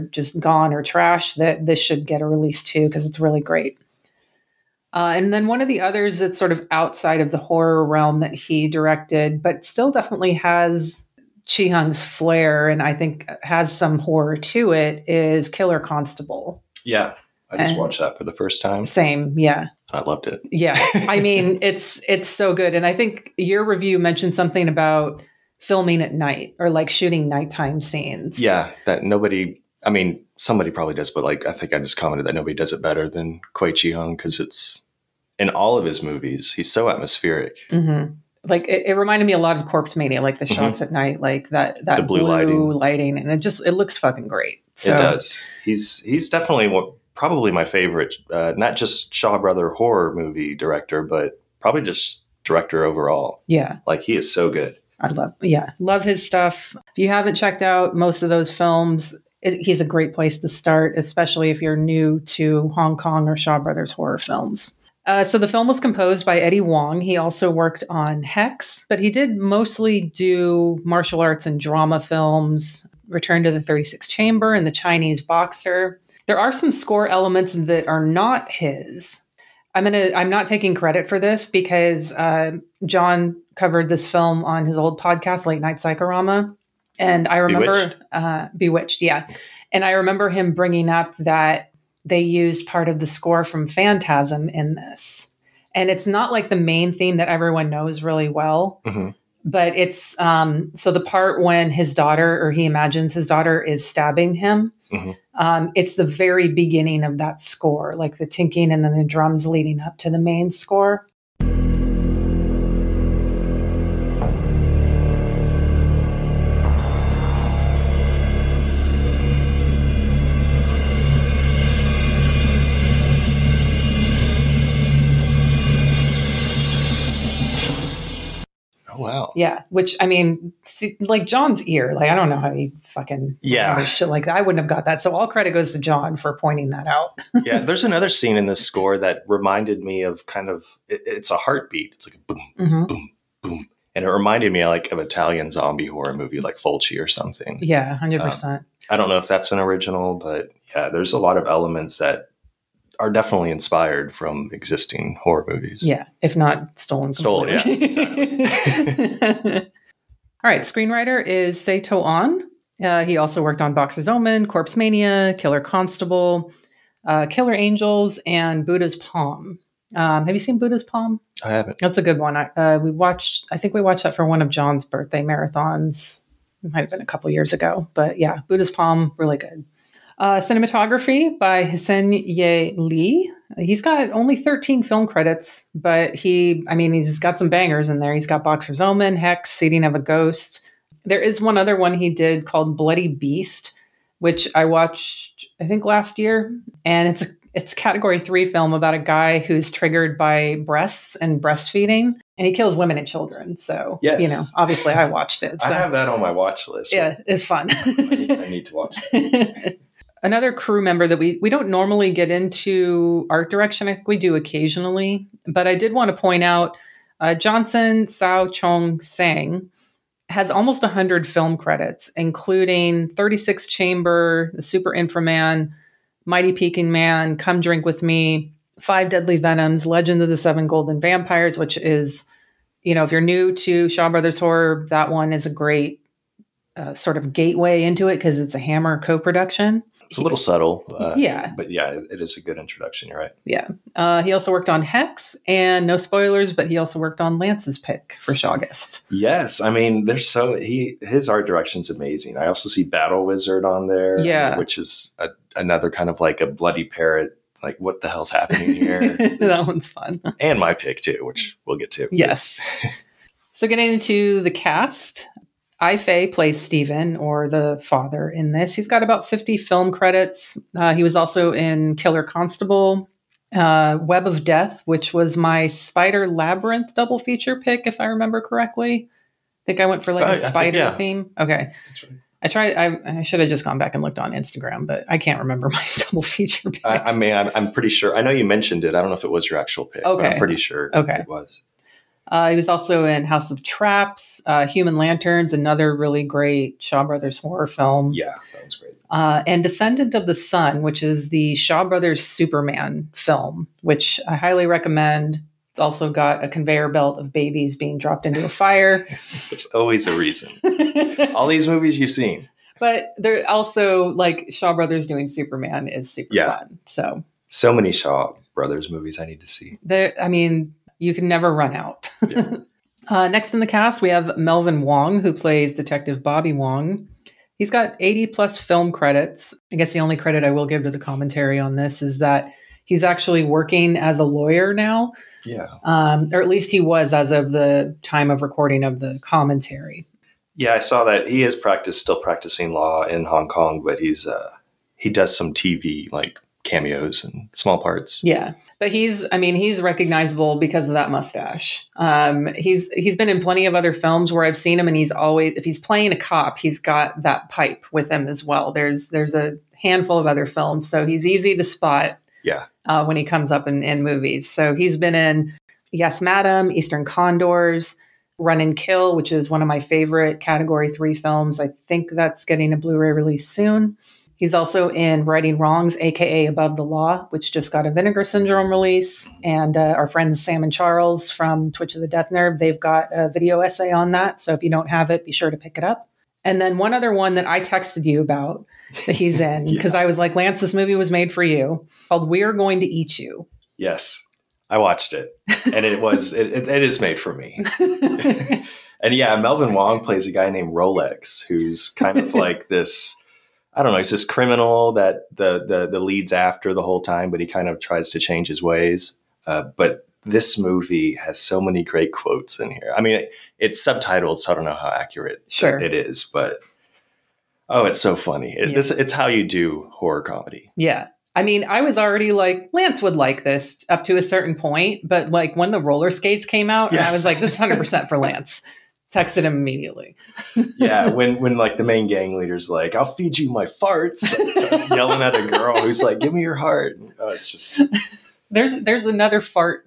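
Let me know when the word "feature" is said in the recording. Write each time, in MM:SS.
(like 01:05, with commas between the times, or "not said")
04:37, 04:46.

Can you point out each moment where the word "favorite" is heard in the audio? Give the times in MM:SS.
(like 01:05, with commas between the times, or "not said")
00:47, 06:09.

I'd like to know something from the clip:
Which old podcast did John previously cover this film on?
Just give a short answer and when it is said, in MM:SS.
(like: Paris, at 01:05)
Late Night Psychorama, at 01:25.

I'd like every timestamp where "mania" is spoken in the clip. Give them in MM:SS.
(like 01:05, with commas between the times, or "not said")
00:39, 02:44.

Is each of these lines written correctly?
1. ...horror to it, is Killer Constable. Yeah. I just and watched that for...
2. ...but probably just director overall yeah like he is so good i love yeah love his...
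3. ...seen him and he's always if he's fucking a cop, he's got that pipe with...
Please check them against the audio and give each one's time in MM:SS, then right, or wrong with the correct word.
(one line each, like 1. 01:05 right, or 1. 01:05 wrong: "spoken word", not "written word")
1. 00:13 right
2. 00:51 right
3. 05:54 wrong: "playing", not "fucking".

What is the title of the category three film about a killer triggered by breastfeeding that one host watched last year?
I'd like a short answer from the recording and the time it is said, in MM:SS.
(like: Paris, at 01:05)
Bloody Beast, at 03:12.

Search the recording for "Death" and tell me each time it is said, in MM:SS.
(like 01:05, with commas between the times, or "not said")
04:34, 06:22.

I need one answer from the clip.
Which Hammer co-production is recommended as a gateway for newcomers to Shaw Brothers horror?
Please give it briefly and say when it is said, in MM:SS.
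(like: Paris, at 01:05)
Legend of the Seven Golden Vampires, at 03:49.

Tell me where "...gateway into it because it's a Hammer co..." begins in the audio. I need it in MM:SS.
03:57.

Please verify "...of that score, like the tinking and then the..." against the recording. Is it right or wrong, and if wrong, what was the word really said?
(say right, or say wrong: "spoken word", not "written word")
right.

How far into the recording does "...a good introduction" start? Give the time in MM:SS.
04:02.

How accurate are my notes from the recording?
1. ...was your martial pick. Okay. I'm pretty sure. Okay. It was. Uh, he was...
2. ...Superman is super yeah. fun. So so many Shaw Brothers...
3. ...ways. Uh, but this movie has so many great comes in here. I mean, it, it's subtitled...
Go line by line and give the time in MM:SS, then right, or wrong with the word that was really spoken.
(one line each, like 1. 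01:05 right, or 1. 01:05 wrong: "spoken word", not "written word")
1. 04:49 wrong: "actual", not "martial"
2. 05:15 right
3. 06:48 wrong: "quotes", not "comes".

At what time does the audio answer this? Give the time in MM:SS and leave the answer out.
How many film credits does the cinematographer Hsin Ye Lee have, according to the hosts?
03:04.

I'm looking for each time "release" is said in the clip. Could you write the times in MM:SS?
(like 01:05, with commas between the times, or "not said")
00:02, 06:13, 06:18.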